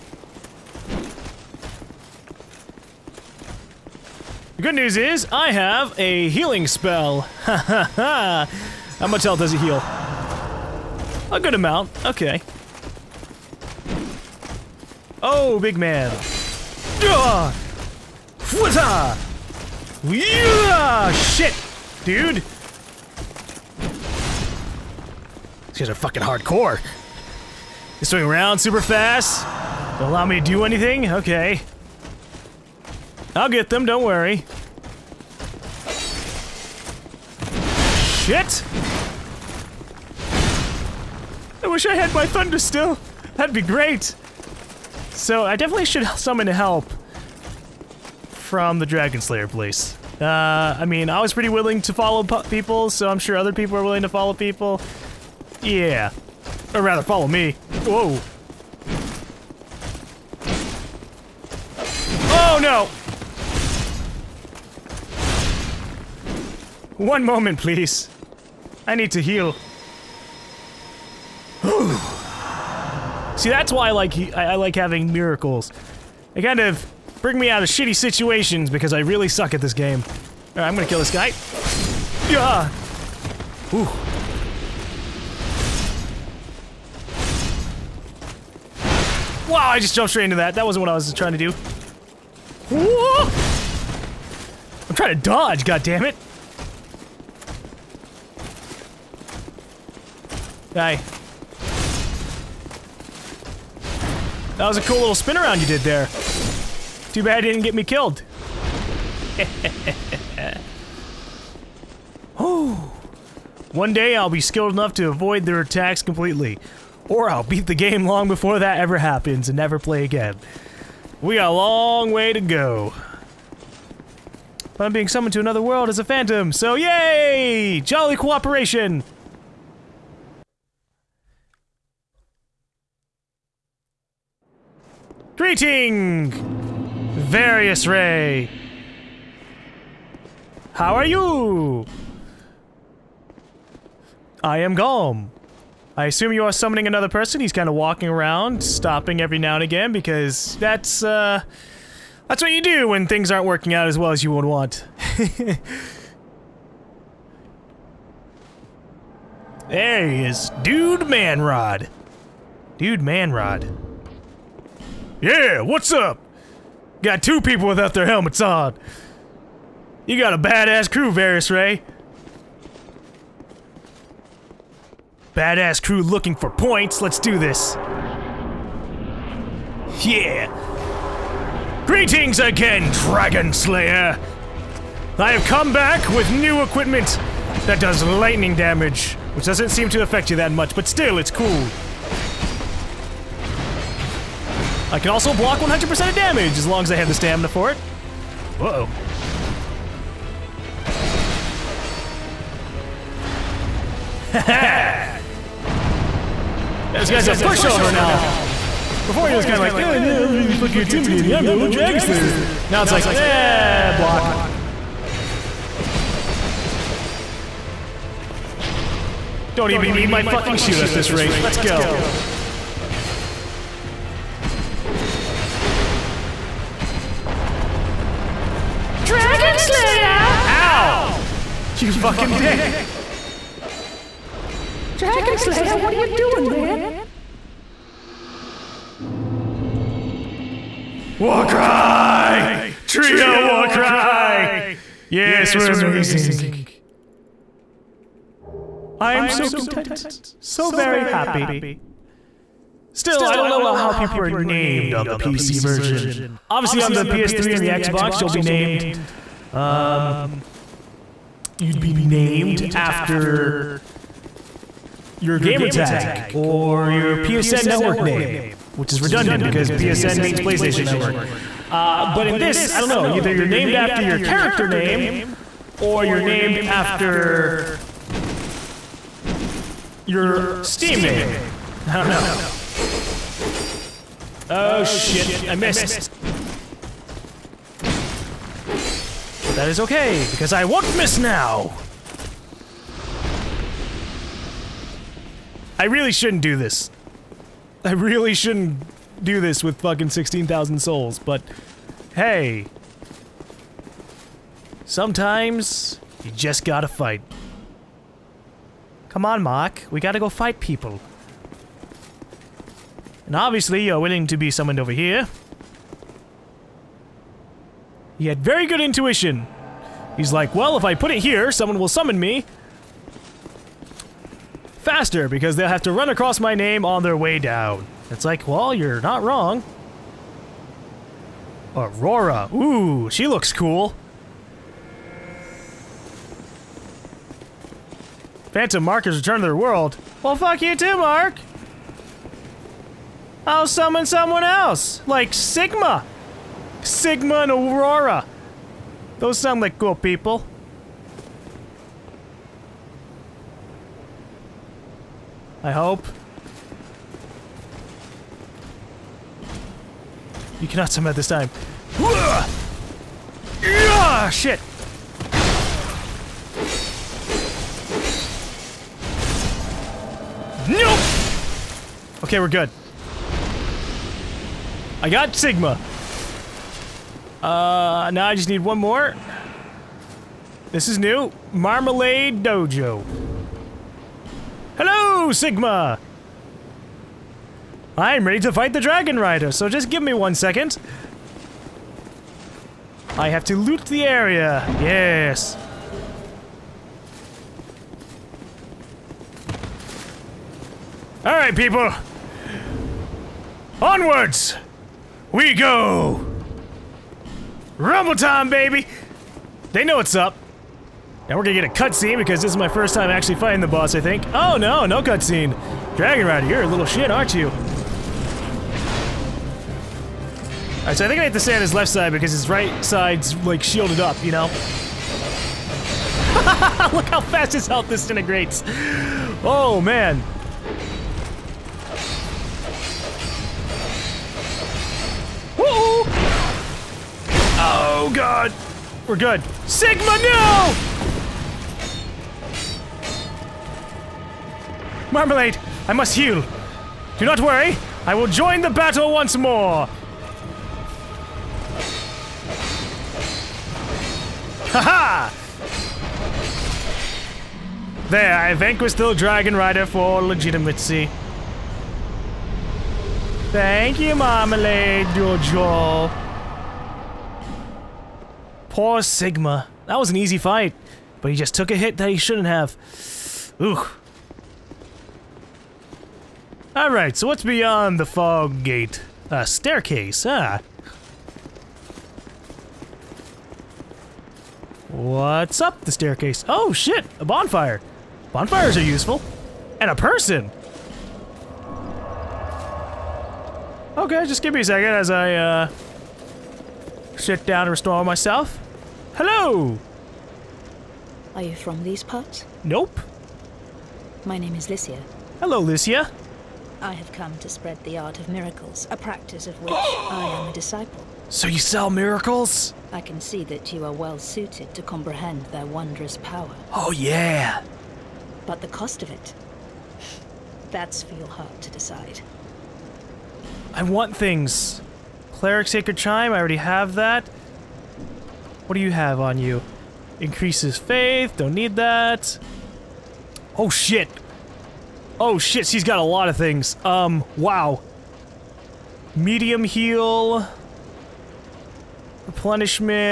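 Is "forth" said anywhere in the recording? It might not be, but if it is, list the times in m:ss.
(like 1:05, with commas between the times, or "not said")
not said.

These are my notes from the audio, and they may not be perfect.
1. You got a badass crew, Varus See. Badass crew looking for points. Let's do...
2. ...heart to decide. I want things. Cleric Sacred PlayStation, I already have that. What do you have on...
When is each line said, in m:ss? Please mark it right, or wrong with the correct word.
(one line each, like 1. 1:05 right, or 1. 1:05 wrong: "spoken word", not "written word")
1. 2:50 wrong: "Ray", not "See"
2. 8:41 wrong: "Chime", not "PlayStation".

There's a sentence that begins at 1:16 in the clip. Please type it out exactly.
They kind of bring me out of shitty situations because I really suck at this game.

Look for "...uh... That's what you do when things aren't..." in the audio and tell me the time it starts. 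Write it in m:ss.
2:31.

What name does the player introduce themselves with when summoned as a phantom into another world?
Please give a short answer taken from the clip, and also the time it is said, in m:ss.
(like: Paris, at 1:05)
Golem, at 2:24.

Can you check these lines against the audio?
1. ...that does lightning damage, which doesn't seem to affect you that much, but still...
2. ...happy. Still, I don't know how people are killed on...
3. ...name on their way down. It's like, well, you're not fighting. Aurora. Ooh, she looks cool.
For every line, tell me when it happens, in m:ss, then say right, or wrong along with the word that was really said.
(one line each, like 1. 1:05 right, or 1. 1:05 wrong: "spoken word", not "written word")
1. 3:07 right
2. 4:11 wrong: "named", not "killed"
3. 5:26 wrong: "wrong", not "fighting".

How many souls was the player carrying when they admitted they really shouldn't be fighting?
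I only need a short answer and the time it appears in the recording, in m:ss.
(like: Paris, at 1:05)
16,000, at 5:00.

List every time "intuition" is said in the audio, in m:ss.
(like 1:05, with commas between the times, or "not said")
5:18.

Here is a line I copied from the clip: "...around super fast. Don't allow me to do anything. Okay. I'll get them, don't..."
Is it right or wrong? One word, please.
right.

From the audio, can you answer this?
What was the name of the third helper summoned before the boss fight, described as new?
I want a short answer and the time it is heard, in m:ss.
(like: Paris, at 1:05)
Marmalade Dojo, at 6:21.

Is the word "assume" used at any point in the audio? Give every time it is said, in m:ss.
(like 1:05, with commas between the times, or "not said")
2:26.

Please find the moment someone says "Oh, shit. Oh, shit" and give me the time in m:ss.
8:53.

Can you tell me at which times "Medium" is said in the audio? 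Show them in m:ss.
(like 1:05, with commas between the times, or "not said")
8:59.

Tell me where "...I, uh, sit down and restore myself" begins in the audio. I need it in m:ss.
8:15.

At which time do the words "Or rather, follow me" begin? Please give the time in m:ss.
0:56.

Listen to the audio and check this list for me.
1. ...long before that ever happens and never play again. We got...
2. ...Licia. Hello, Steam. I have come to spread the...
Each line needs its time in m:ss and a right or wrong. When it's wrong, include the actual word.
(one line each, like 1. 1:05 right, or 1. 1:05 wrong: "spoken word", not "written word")
1. 1:58 right
2. 8:24 wrong: "Licia", not "Steam".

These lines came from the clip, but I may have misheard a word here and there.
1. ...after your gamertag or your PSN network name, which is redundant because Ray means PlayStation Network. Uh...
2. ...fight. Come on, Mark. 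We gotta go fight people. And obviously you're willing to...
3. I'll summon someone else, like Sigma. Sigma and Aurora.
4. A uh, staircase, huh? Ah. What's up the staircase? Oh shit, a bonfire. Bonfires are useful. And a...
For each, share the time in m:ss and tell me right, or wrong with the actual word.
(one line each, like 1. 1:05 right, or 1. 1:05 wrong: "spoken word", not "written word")
1. 4:22 wrong: "PSN", not "Ray"
2. 5:06 right
3. 5:43 right
4. 7:59 right.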